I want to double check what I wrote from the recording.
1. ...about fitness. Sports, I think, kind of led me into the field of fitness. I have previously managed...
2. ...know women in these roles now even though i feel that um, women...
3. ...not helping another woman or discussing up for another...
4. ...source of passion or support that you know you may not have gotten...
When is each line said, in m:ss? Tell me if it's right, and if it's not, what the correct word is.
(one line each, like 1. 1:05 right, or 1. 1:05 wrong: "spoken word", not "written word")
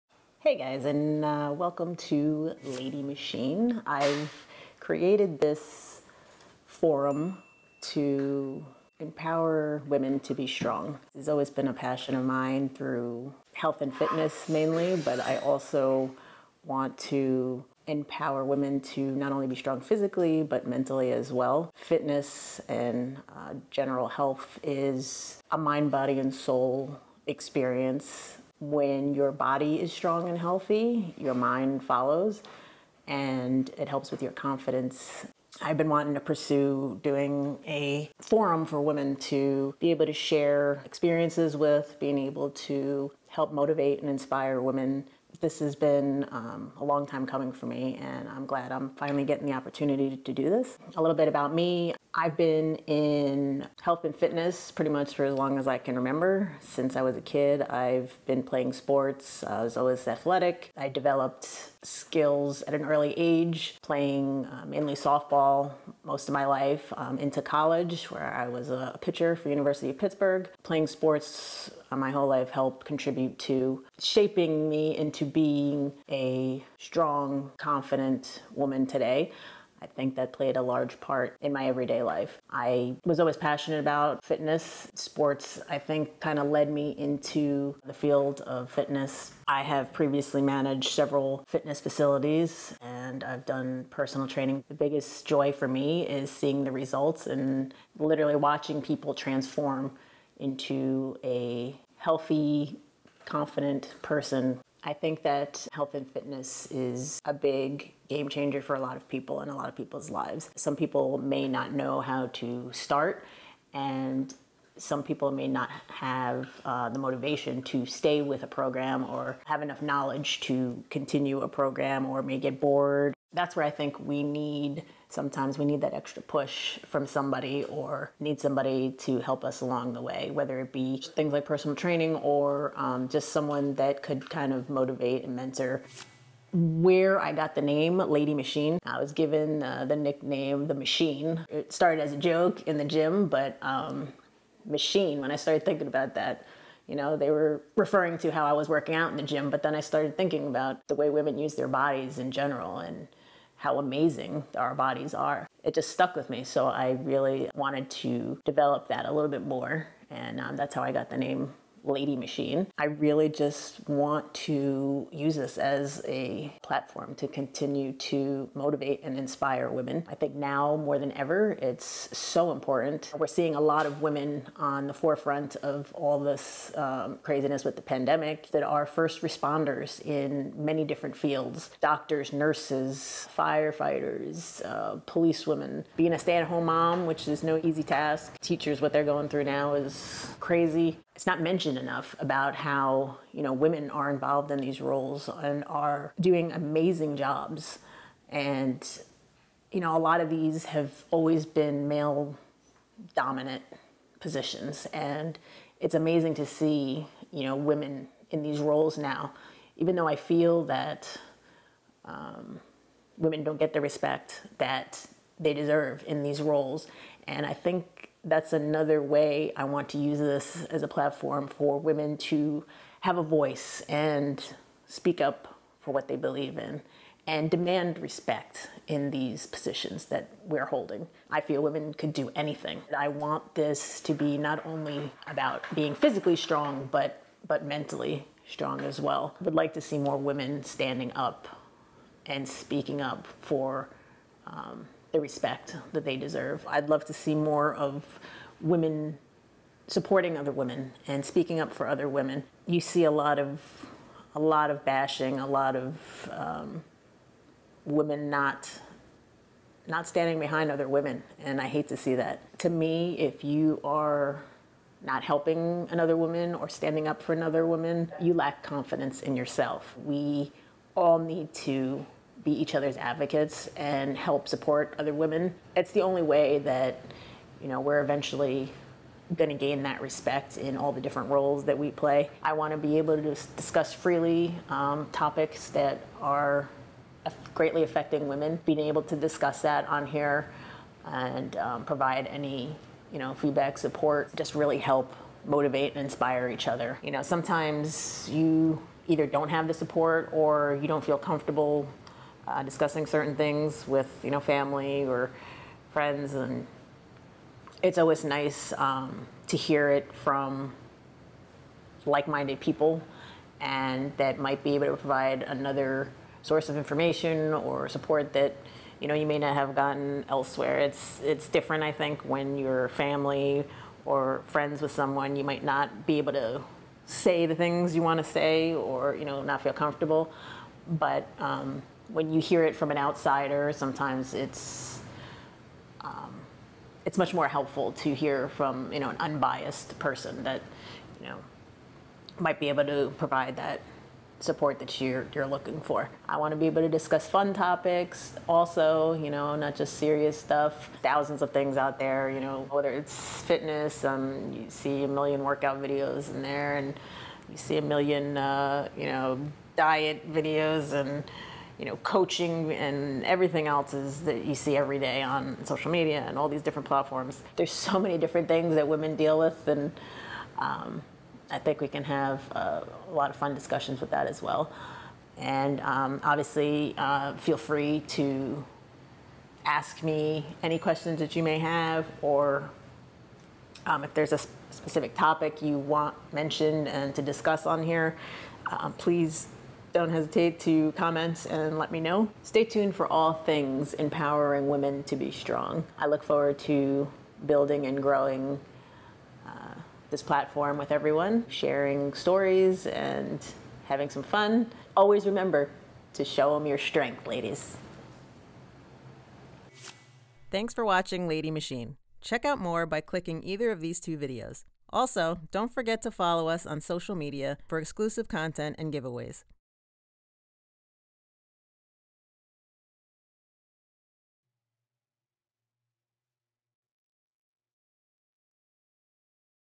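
1. 1:23 right
2. 3:27 right
3. 4:25 wrong: "standing", not "discussing"
4. 5:16 wrong: "information", not "passion".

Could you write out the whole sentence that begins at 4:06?
I'd love to see more of women supporting other women and speaking up for other women.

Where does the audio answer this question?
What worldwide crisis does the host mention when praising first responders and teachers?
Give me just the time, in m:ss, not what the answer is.
2:57.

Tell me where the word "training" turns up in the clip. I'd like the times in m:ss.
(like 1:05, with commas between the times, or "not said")
1:34, 2:11.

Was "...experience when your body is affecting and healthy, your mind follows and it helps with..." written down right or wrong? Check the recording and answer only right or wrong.
wrong.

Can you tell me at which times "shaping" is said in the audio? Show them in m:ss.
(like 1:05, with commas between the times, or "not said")
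1:14.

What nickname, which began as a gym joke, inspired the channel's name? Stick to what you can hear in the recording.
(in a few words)
The Machine.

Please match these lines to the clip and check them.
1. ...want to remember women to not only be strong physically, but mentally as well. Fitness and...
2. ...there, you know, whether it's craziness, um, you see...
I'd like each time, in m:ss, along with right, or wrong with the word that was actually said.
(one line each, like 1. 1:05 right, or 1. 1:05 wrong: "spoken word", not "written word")
1. 0:16 wrong: "empower", not "remember"
2. 5:51 wrong: "fitness", not "craziness".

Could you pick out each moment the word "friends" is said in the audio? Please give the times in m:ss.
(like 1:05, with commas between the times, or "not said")
5:05, 5:24.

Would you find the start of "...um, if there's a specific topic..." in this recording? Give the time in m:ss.
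6:23.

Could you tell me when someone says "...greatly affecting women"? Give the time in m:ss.
4:47.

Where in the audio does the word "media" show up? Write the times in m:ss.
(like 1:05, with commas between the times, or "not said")
6:05, 6:57.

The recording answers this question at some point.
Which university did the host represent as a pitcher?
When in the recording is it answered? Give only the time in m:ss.
1:09.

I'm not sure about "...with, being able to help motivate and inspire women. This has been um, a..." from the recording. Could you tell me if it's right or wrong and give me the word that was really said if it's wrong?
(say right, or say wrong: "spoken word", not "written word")
right.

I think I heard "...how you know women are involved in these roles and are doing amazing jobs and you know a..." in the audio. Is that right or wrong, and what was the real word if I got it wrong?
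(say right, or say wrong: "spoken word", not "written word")
right.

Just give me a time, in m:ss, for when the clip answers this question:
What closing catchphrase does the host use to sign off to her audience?
6:46.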